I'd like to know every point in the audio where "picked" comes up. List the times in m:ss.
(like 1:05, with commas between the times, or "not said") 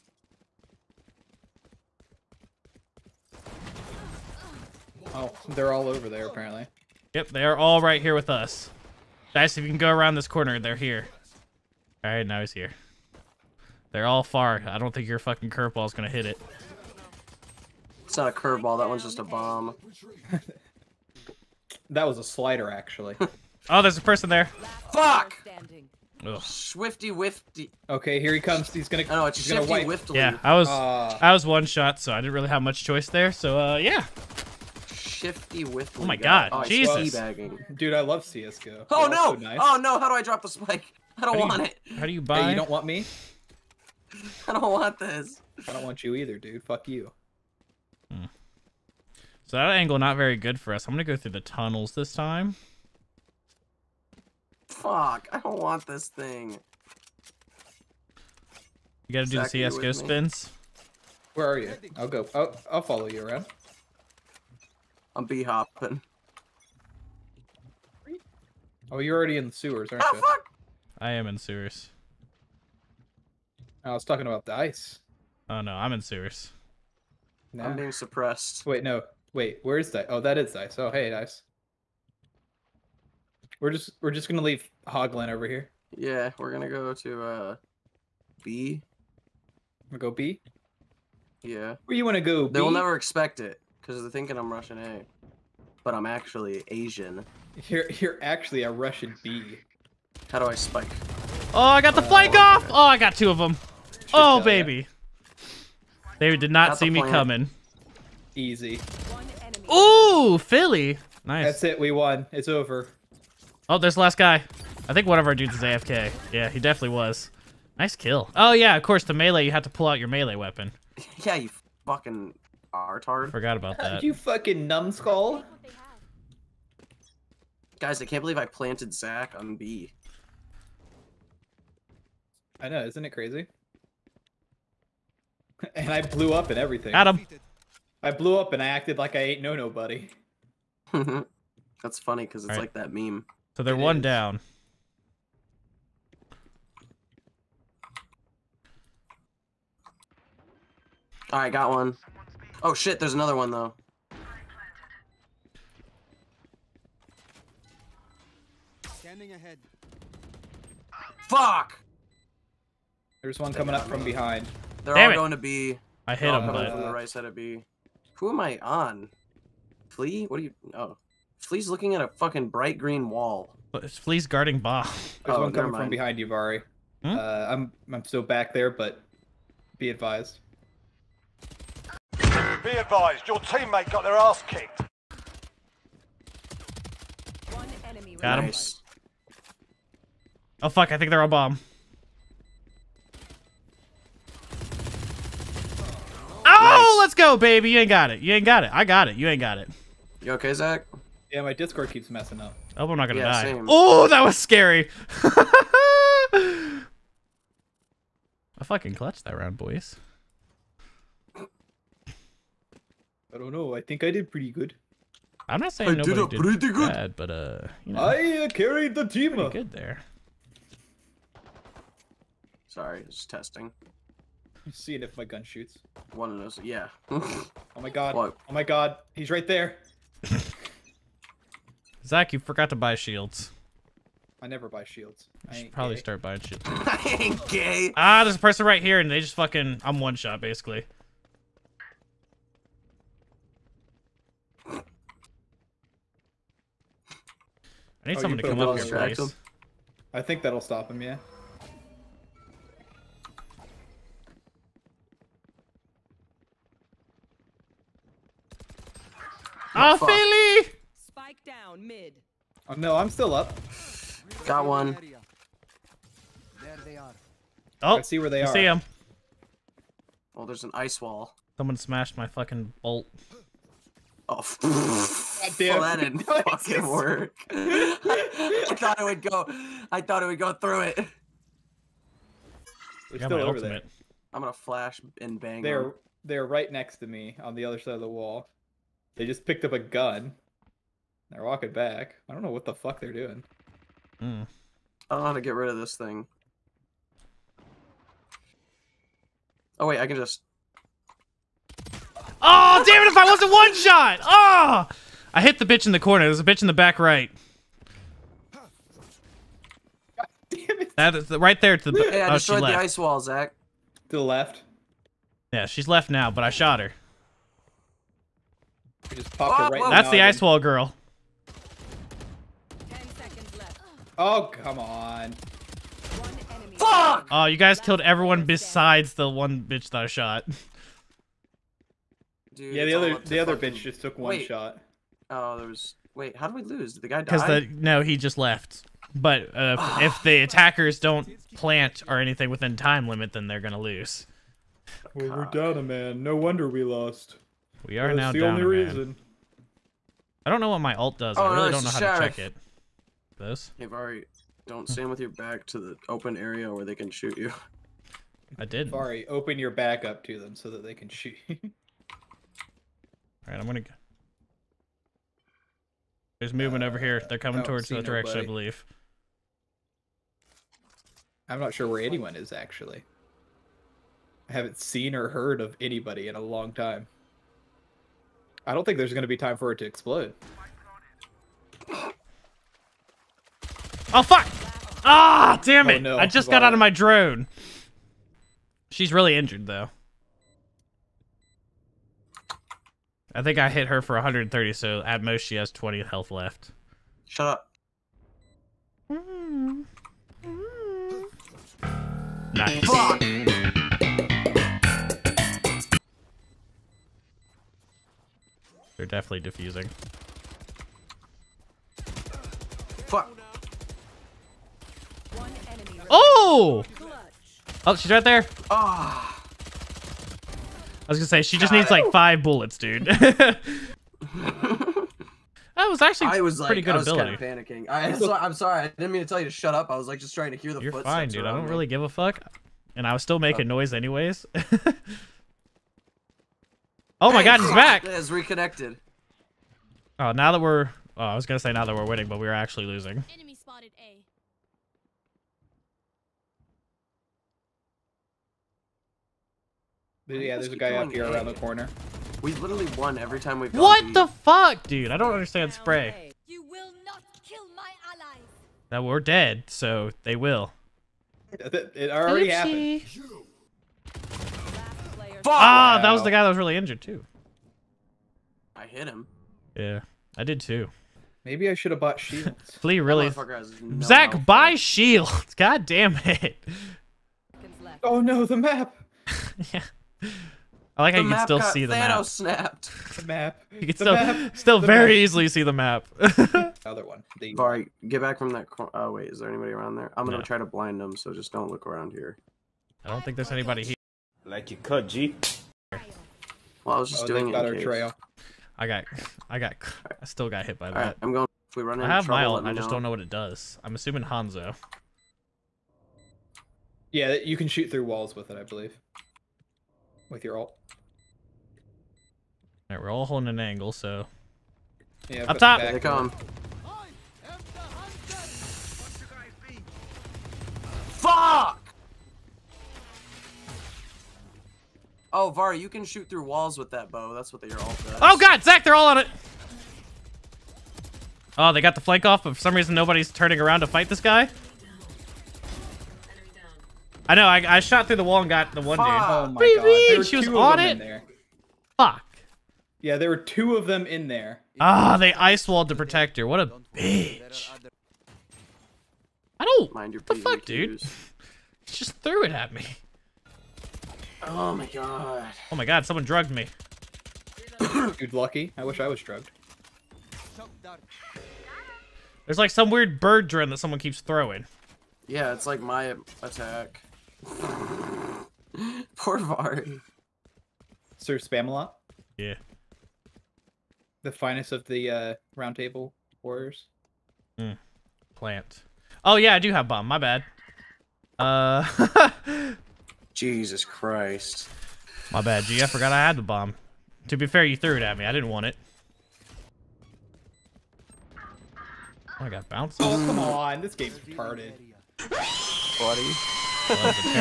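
4:49.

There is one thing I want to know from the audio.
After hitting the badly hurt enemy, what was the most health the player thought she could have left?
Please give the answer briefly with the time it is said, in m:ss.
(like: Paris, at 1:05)
20, at 6:35.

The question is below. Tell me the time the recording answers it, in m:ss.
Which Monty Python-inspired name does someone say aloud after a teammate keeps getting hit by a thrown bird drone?
9:31.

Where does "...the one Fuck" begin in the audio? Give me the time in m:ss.
8:58.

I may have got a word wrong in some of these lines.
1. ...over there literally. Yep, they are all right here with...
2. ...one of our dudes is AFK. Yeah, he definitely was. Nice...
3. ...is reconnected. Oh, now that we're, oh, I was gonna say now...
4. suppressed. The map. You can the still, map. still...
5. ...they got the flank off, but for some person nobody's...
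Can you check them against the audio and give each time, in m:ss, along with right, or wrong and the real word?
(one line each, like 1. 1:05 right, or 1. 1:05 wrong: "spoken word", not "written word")
1. 0:05 wrong: "apparently", not "literally"
2. 1:55 right
3. 7:18 right
4. 8:02 wrong: "snapped", not "suppressed"
5. 8:51 wrong: "reason", not "person".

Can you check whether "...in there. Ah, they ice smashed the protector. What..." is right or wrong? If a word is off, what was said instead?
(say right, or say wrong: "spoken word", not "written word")
wrong: "walled", not "smashed".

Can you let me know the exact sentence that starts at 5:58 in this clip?
Vari, open your back up to them so that they can shoot you.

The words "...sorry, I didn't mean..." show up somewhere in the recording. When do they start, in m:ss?
7:08.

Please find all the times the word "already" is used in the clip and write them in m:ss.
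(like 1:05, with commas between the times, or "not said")
1:09, 7:42.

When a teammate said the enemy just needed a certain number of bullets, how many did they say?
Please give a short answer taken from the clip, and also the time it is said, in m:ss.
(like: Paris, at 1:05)
five, at 7:02.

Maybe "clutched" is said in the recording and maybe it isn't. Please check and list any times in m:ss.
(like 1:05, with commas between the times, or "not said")
3:28.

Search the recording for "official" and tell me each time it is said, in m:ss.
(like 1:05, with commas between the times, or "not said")
not said.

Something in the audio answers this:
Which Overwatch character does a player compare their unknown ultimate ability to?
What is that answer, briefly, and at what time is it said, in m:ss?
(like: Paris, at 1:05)
Hanzo, at 8:24.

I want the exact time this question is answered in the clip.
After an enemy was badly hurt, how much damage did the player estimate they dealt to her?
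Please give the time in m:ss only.
6:34.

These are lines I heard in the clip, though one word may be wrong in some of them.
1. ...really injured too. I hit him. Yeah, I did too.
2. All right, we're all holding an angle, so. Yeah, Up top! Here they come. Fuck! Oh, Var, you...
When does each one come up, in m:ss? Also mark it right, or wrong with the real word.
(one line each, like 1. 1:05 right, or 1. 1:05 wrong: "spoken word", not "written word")
1. 7:46 right
2. 8:32 right.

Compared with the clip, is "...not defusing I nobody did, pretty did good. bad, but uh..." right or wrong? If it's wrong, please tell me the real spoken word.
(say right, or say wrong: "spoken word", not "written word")
wrong: "saying", not "defusing".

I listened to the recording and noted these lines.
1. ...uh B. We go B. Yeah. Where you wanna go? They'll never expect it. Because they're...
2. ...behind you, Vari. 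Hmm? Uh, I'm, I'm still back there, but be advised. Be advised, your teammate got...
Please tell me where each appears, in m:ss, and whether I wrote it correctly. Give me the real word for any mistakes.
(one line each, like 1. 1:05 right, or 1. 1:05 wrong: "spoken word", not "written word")
1. 1:27 right
2. 2:55 right.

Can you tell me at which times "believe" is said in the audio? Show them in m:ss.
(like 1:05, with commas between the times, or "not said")
2:08, 6:08, 8:28.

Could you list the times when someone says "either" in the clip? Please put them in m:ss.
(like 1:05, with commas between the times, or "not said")
0:46.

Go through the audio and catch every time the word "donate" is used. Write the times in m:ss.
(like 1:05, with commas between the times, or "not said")
not said.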